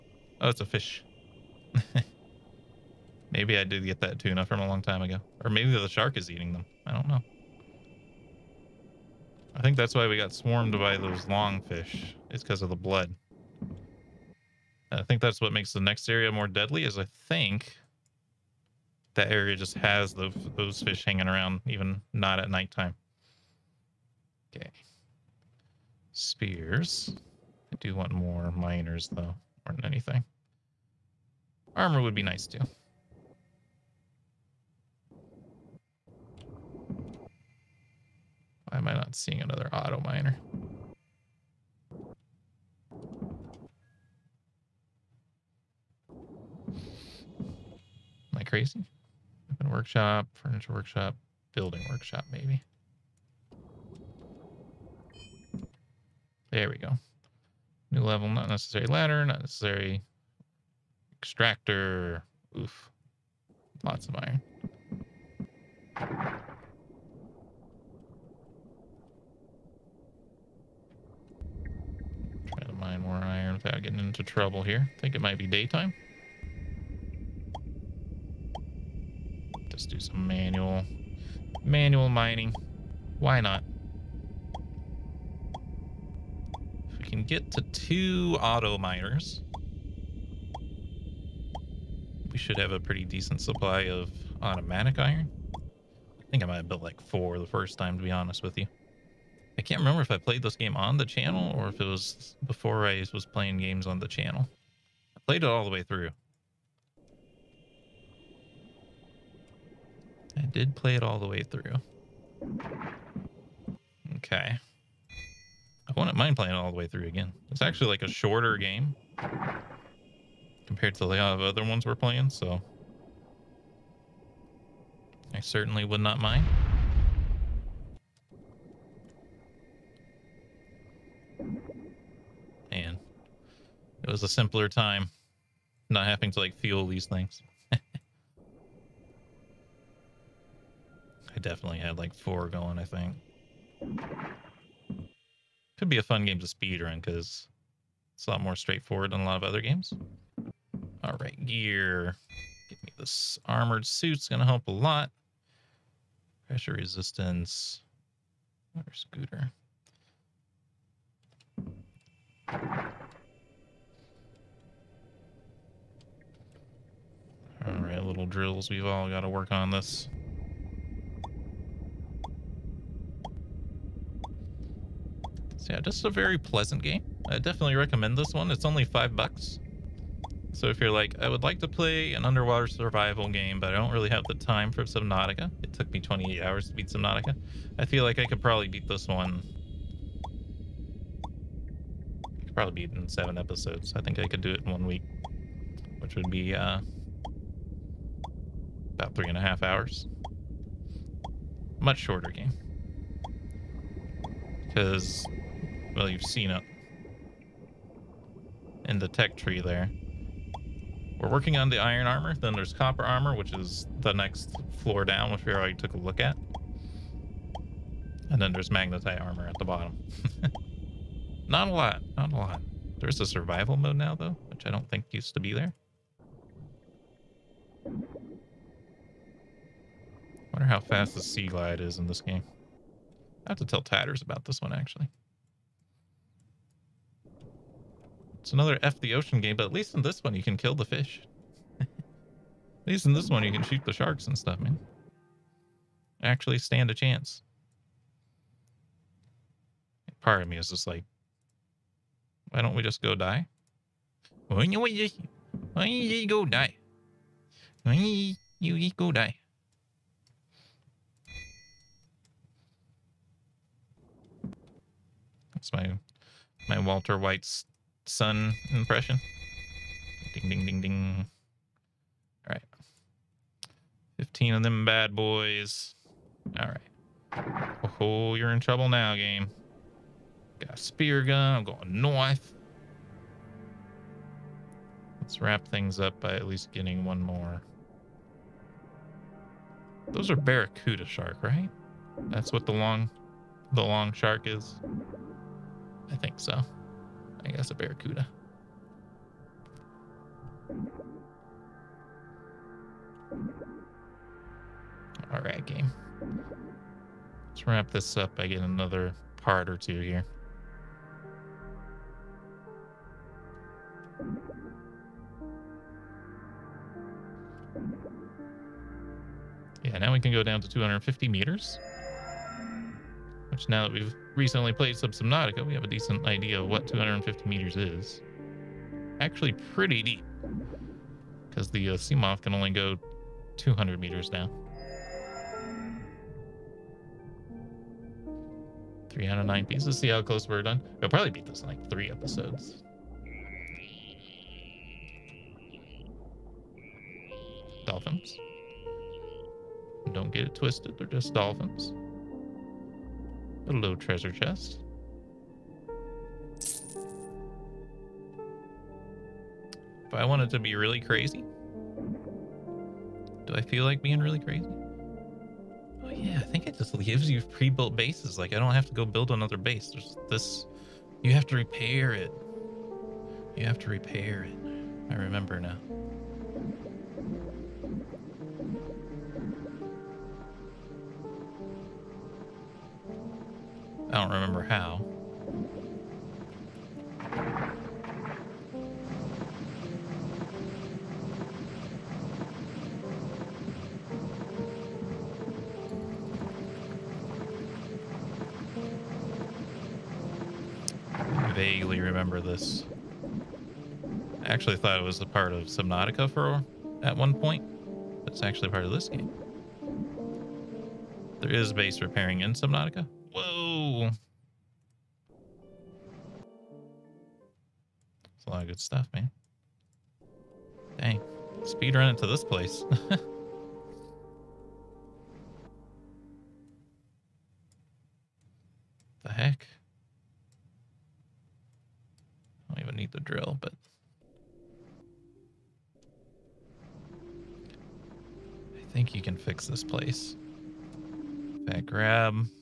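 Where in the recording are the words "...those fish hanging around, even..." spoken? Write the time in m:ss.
0:20.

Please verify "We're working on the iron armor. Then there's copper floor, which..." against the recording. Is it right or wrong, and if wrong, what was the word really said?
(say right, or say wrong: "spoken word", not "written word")
wrong: "armor", not "floor".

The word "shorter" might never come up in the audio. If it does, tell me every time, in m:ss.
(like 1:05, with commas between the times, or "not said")
1:58, 3:21.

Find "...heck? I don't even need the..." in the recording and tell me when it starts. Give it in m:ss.
7:09.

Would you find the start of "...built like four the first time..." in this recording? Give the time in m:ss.
1:36.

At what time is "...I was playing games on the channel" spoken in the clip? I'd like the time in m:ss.
1:42.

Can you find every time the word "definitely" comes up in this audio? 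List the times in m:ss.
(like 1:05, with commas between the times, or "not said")
2:21, 2:57.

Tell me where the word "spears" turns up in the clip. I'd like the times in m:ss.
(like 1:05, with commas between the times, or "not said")
0:26, 4:40.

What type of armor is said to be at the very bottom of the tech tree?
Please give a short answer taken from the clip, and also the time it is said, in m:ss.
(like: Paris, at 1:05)
Magnetite armor, at 3:38.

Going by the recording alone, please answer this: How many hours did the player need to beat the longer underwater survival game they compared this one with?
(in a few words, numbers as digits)
28.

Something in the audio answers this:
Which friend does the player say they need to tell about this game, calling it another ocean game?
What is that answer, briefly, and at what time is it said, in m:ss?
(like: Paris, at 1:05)
Tatters, at 3:53.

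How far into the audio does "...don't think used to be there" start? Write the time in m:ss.
3:44.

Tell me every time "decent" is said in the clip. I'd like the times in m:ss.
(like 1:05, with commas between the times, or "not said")
1:33, 5:25.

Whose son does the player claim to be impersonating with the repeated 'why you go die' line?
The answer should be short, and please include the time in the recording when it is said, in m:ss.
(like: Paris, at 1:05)
Walter White's, at 4:26.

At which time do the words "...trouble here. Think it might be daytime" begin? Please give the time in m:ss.
1:14.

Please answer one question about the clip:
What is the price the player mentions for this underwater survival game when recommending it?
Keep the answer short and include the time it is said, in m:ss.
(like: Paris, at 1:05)
5 dollars, at 2:58.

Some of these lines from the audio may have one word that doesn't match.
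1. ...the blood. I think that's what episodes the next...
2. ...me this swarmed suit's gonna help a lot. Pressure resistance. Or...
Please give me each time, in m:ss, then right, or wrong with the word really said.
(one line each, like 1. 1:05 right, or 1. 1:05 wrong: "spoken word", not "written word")
1. 0:12 wrong: "makes", not "episodes"
2. 2:32 wrong: "armored", not "swarmed".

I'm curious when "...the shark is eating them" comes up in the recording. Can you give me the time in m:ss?
0:05.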